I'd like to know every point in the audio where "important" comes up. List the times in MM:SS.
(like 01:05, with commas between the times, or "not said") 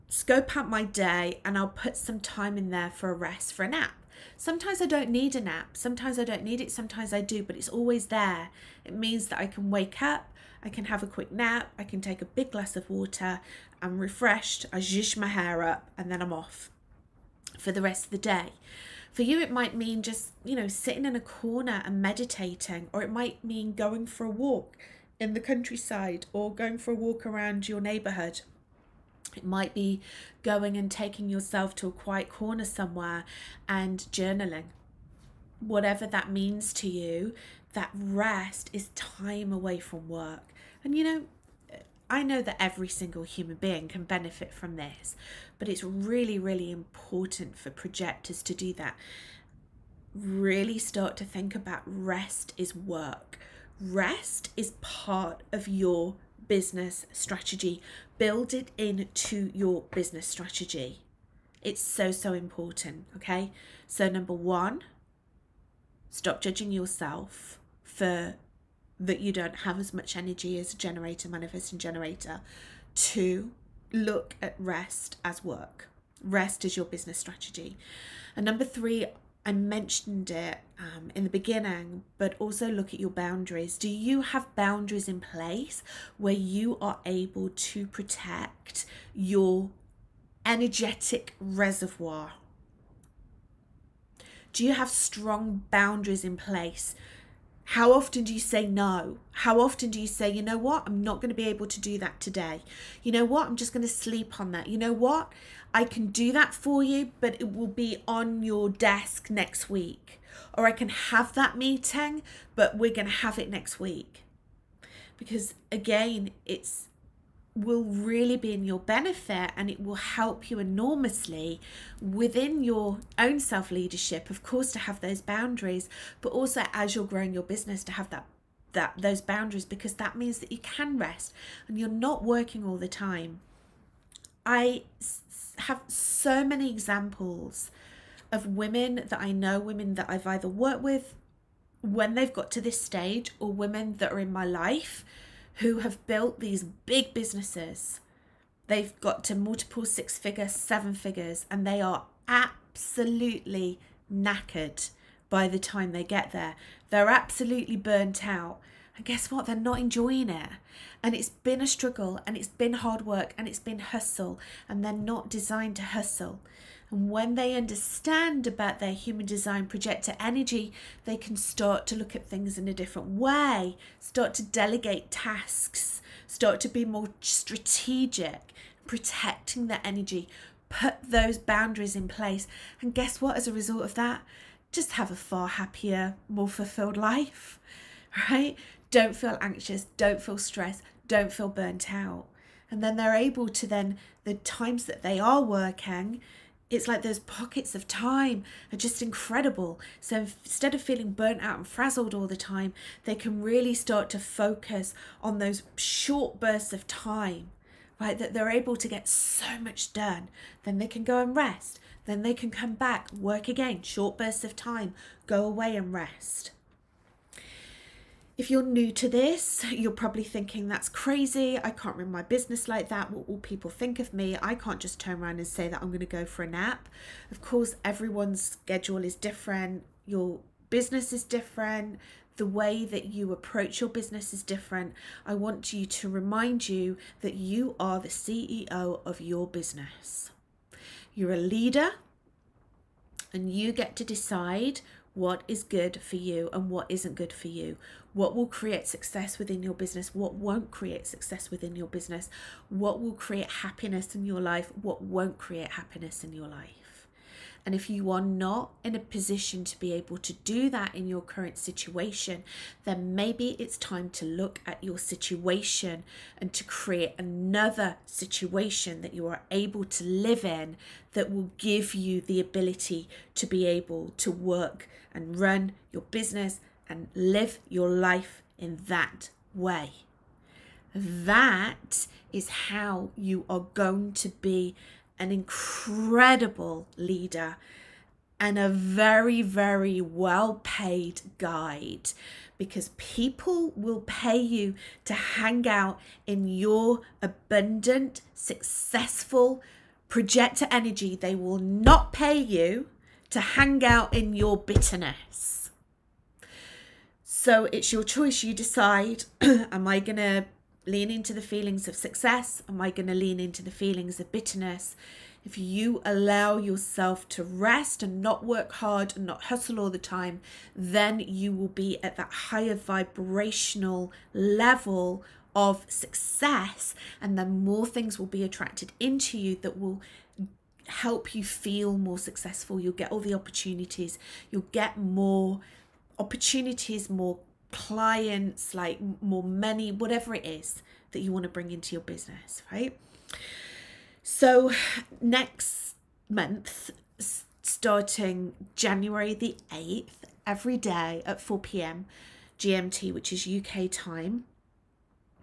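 00:46, 01:02.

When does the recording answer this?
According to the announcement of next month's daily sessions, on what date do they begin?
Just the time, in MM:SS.
05:48.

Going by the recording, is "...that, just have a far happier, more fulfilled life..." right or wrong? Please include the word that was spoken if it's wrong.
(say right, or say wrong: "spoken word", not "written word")
right.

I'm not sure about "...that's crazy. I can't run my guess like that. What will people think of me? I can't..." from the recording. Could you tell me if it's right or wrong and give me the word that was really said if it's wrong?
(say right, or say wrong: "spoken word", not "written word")
wrong: "business", not "guess".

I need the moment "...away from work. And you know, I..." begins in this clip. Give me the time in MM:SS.
00:39.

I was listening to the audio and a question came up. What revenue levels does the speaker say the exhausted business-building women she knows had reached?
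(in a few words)
multiple six figures, seven figures.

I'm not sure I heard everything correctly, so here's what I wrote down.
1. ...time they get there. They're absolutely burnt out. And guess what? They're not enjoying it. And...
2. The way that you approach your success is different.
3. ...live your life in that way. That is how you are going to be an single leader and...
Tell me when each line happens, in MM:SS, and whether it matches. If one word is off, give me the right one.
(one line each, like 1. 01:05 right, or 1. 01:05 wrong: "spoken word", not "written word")
1. 02:35 right
2. 03:52 wrong: "business", not "success"
3. 04:37 wrong: "incredible", not "single".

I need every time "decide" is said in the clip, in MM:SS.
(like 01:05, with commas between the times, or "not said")
04:04, 05:08.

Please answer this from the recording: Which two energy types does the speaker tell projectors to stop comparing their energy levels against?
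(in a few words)
generator, manifesting generator.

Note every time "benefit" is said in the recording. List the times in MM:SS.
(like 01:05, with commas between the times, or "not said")
00:44, 01:58.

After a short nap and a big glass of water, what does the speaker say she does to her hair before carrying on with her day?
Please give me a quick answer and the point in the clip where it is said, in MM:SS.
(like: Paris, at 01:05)
zhuzh my hair up, at 00:14.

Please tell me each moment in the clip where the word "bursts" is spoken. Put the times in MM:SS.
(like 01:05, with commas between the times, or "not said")
03:26, 03:34.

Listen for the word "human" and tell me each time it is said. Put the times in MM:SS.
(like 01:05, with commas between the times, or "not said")
00:43, 02:48.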